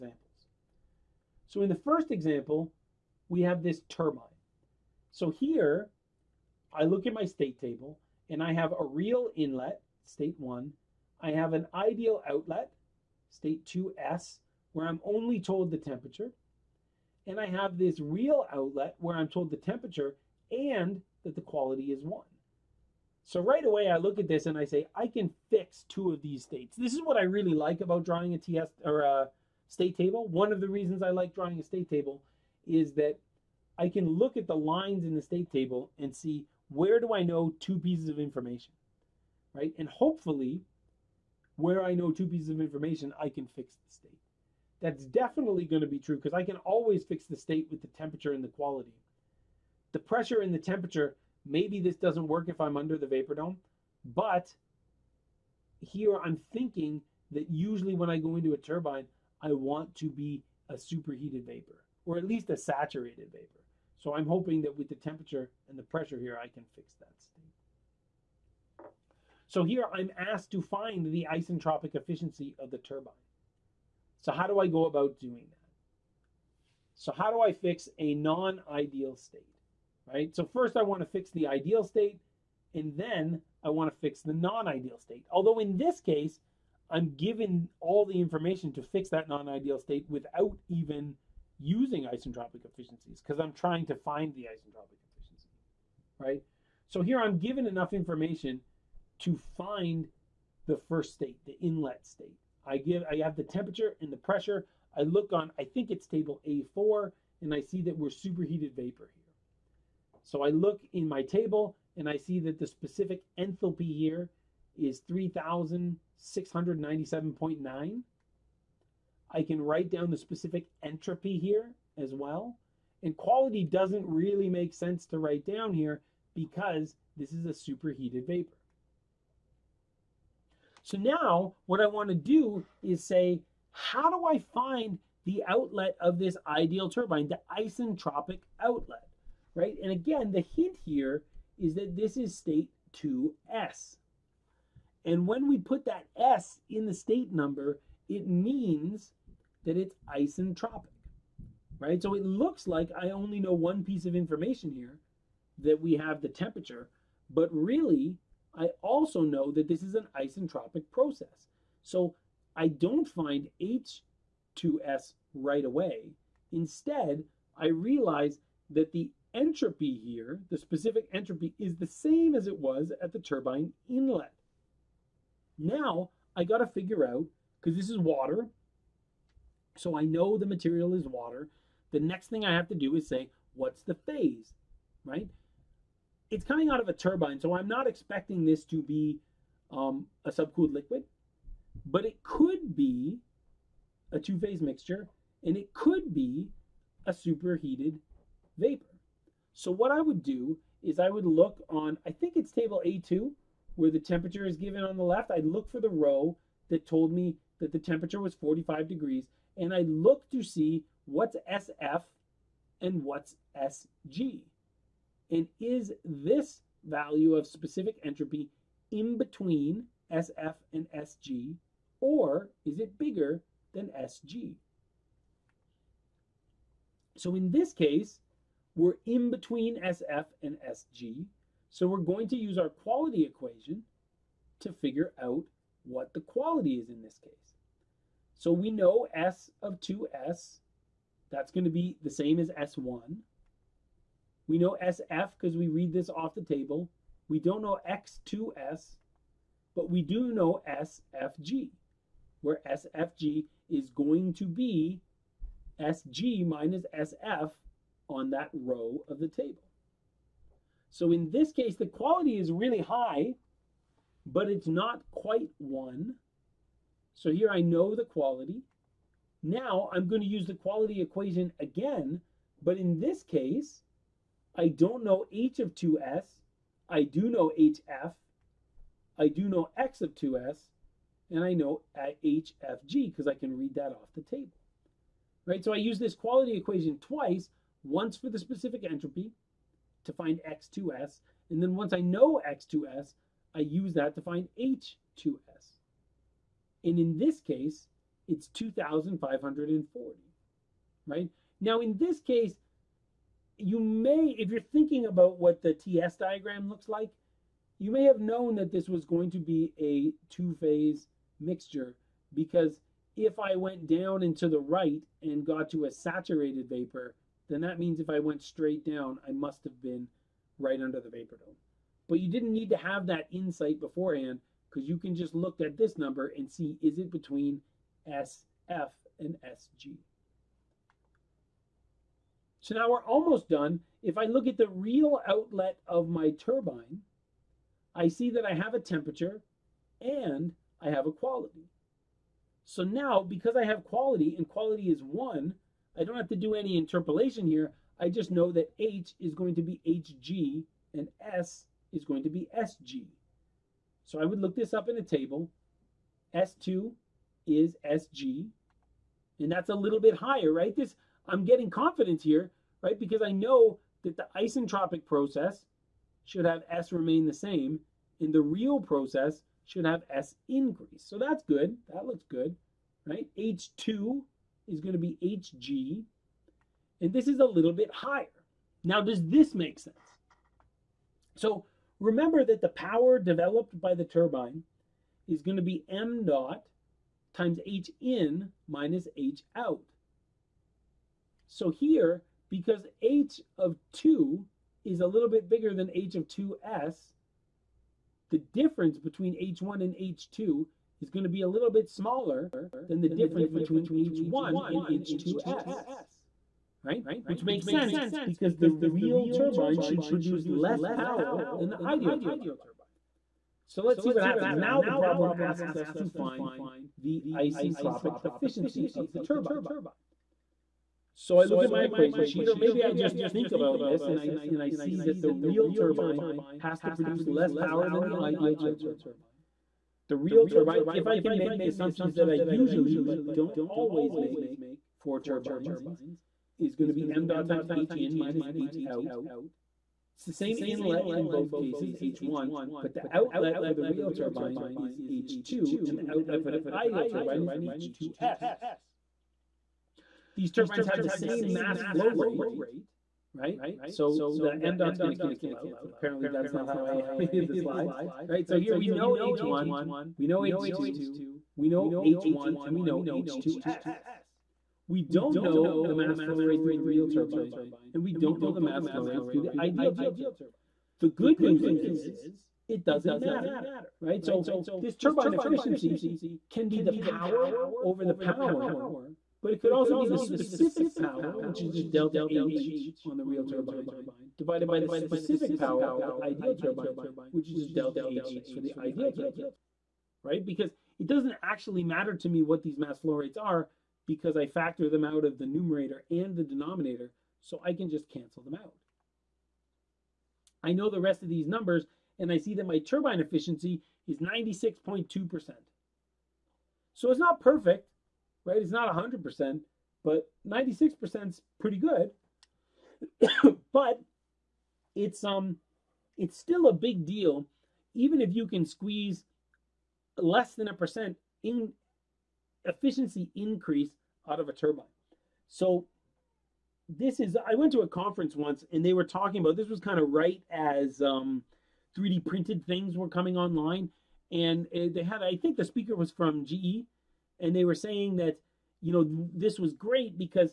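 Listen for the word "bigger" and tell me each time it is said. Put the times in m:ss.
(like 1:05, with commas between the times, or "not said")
3:42, 6:35.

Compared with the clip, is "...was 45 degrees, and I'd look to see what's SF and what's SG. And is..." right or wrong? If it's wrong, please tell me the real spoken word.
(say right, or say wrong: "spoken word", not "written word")
right.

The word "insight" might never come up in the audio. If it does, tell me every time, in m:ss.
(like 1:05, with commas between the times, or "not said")
5:23.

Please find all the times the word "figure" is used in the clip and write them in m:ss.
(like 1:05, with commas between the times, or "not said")
2:56, 3:54.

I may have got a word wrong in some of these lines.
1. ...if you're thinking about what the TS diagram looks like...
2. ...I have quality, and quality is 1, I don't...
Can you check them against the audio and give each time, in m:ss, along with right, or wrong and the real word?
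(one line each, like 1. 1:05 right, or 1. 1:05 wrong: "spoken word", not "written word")
1. 5:04 right
2. 5:43 right.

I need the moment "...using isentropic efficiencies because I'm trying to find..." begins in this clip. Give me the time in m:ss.
1:31.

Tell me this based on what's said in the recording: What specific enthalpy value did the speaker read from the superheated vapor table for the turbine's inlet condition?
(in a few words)
3697.9.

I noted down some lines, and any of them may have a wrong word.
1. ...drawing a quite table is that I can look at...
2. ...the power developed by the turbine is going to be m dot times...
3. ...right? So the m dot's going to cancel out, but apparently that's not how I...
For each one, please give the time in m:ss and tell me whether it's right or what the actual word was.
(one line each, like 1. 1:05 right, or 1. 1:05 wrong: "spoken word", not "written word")
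1. 0:31 wrong: "state", not "quite"
2. 6:22 right
3. 7:33 right.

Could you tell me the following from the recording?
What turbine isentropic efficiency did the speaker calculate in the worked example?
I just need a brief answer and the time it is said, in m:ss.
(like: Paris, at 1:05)
96.2%, at 8:24.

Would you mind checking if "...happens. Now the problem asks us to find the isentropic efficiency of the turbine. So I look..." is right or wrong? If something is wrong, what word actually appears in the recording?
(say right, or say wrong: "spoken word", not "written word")
right.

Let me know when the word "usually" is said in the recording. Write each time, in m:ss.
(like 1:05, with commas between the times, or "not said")
0:57, 7:12.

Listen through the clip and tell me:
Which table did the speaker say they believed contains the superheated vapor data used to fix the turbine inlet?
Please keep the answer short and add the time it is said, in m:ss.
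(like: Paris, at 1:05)
Table A4, at 1:46.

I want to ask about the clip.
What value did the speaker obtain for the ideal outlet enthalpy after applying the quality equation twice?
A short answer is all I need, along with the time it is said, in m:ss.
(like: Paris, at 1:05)
2540, at 4:58.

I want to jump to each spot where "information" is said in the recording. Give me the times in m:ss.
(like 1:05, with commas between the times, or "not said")
0:38, 0:42, 1:28, 1:37, 2:34.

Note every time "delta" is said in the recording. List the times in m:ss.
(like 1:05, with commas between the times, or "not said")
8:01, 8:07.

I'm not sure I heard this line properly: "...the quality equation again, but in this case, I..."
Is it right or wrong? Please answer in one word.
right.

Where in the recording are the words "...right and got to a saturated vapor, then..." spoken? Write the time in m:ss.
5:14.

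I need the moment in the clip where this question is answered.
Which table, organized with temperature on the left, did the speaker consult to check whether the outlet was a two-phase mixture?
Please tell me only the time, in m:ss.
3:22.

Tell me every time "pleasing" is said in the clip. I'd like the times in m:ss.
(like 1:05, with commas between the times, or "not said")
not said.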